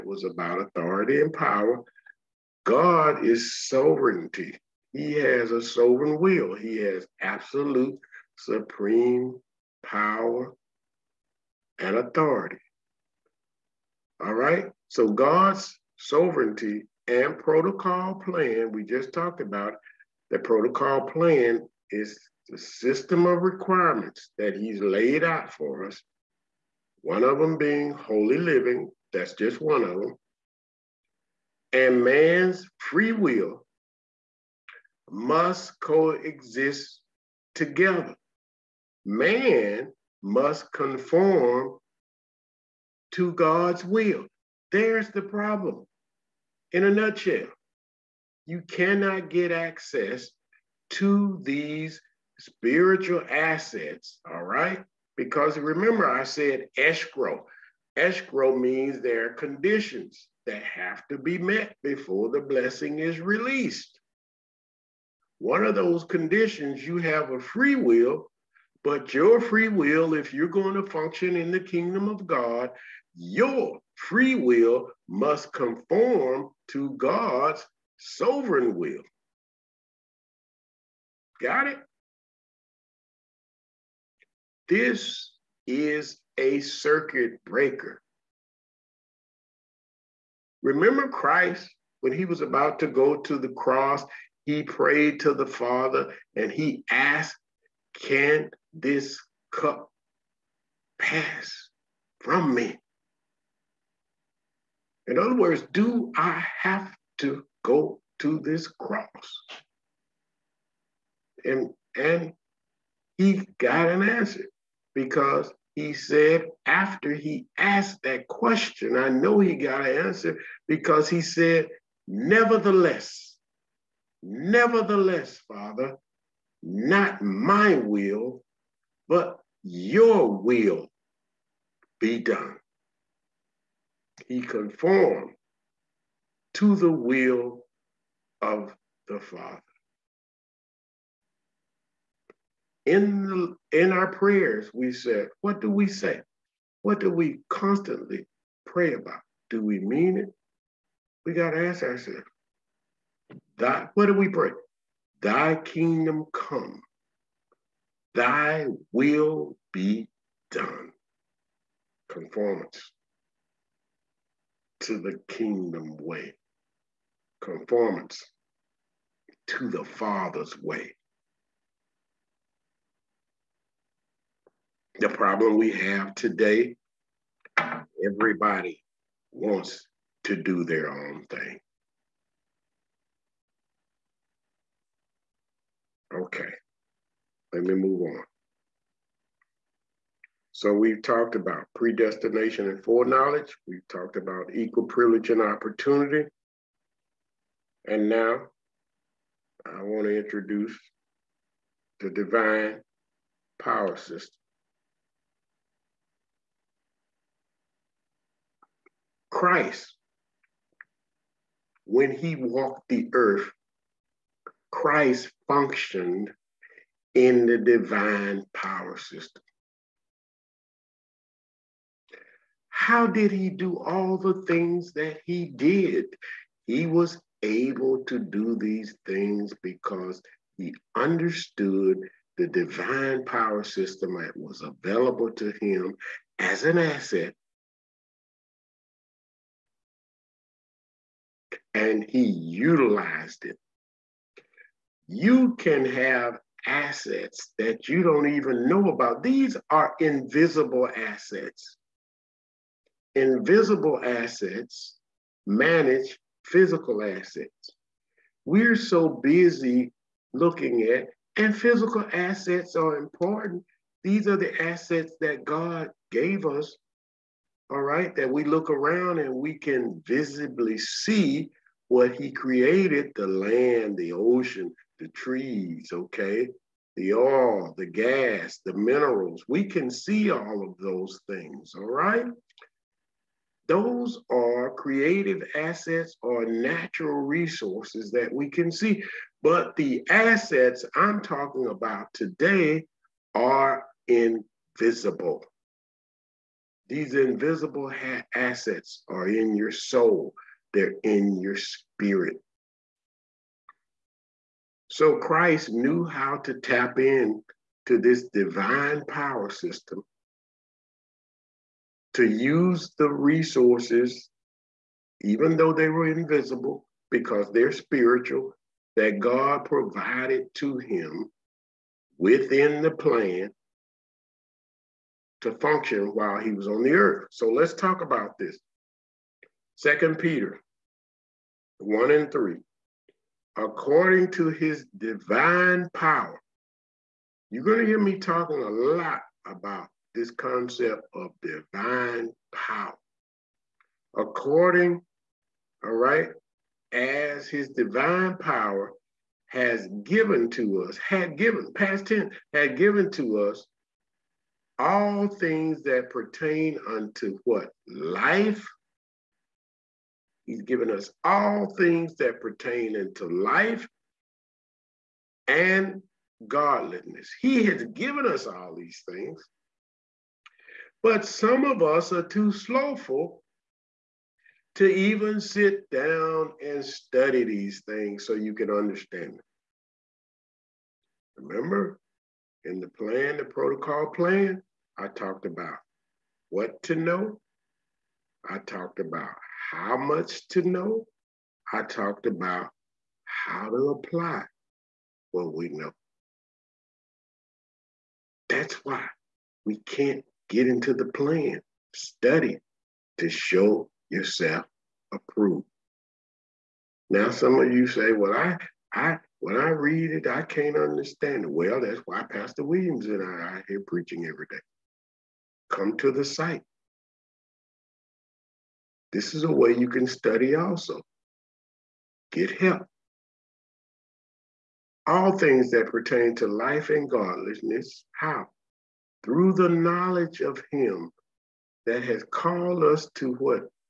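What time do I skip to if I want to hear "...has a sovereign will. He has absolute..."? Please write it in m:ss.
0:05.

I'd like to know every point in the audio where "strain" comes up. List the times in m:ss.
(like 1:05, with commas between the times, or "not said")
not said.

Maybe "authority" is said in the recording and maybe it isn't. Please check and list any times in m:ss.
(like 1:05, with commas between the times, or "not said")
0:00, 0:11.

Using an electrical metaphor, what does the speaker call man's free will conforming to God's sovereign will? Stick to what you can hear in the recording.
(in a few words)
Circuit breaker.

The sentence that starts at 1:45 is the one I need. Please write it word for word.
In other words, do I have to go to this cross?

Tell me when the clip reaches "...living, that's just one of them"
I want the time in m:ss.
0:28.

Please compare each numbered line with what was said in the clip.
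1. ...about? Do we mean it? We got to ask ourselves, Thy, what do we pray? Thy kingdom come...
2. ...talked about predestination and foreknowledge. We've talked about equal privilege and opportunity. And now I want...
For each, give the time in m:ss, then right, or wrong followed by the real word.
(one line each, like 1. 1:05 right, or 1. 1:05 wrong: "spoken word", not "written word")
1. 2:28 right
2. 3:11 right.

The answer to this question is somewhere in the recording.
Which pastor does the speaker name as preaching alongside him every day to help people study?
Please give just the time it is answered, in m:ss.
6:52.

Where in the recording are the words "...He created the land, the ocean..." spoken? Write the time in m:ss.
4:32.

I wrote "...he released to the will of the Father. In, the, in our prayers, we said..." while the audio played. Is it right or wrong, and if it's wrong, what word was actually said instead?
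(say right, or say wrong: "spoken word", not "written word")
wrong: "conformed", not "released".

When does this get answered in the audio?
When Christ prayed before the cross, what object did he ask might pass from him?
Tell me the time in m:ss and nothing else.
1:38.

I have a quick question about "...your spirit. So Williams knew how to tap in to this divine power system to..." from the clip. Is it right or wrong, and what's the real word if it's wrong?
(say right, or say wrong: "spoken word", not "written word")
wrong: "Christ", not "Williams".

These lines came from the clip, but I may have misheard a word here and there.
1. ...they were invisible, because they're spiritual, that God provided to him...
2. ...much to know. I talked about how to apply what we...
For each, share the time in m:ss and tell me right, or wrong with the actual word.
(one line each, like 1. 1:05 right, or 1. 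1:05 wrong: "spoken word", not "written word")
1. 5:15 right
2. 6:29 right.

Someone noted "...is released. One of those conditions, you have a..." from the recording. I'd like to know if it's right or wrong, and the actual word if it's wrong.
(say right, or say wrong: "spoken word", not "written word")
right.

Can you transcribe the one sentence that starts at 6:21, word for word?
Remember, in the plan, the protocol plan, I talked about what to know.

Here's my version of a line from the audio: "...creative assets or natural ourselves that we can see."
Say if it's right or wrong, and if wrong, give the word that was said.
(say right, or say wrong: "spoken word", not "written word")
wrong: "resources", not "ourselves".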